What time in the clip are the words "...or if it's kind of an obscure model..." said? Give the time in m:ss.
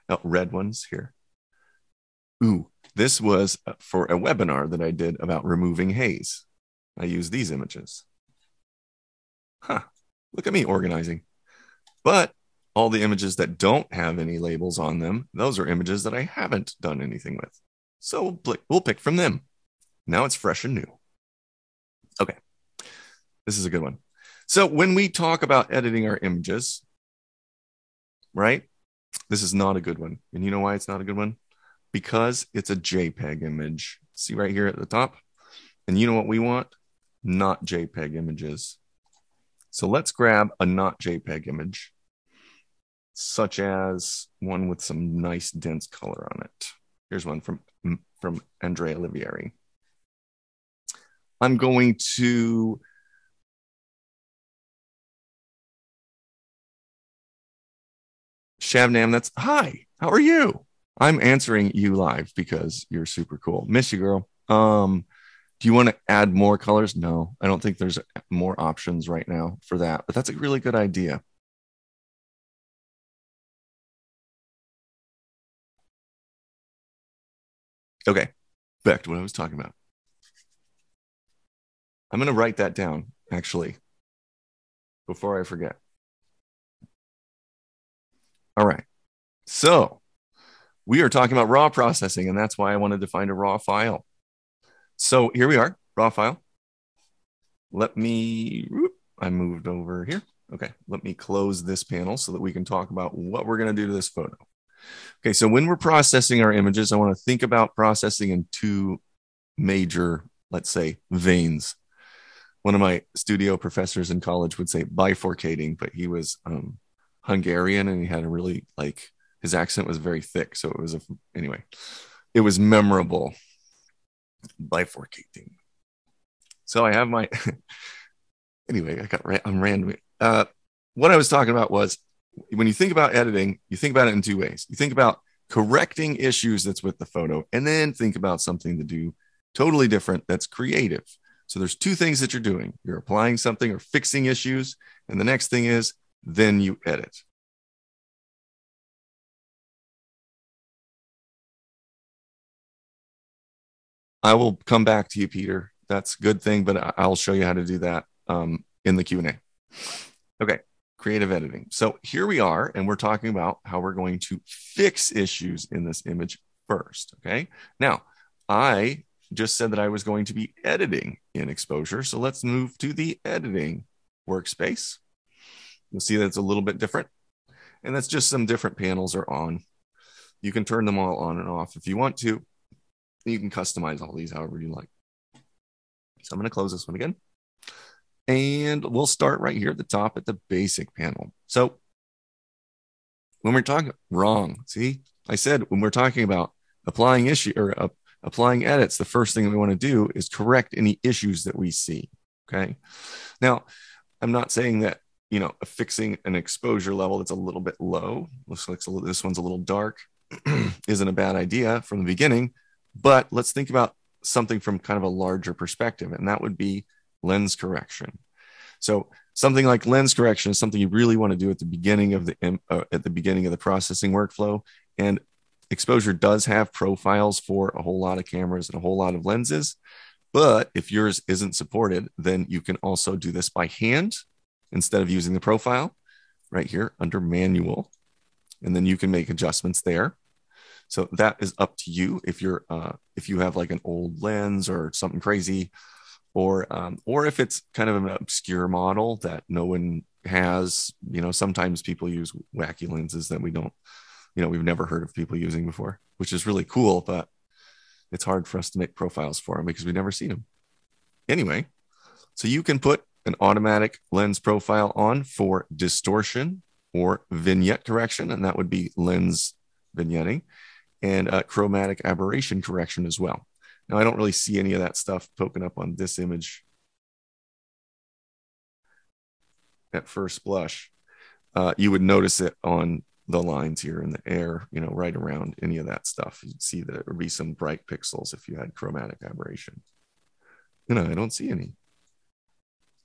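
4:07.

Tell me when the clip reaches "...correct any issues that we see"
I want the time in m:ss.
3:20.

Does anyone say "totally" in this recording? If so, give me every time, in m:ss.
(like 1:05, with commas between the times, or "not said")
2:19.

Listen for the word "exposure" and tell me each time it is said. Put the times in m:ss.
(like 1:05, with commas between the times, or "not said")
2:51, 3:26, 3:45.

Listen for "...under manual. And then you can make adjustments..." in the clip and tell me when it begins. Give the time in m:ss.
3:56.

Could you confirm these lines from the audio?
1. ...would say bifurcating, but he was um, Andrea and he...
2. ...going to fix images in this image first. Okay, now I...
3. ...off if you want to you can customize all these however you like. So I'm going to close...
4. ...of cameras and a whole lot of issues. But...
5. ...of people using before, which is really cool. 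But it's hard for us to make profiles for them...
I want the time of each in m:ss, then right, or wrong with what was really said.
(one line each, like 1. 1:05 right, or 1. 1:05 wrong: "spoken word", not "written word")
1. 1:54 wrong: "Hungarian", not "Andrea"
2. 2:43 wrong: "issues", not "images"
3. 3:01 right
4. 3:48 wrong: "lenses", not "issues"
5. 4:15 right.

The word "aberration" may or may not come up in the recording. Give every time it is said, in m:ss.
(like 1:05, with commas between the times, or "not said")
4:32, 4:49.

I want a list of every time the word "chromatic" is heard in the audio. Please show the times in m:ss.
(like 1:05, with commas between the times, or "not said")
4:31, 4:48.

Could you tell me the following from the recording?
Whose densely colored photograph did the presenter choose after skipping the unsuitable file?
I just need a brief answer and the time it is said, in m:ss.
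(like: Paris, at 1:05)
Andrea Olivieri, at 0:48.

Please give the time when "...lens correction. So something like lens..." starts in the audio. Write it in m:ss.
3:37.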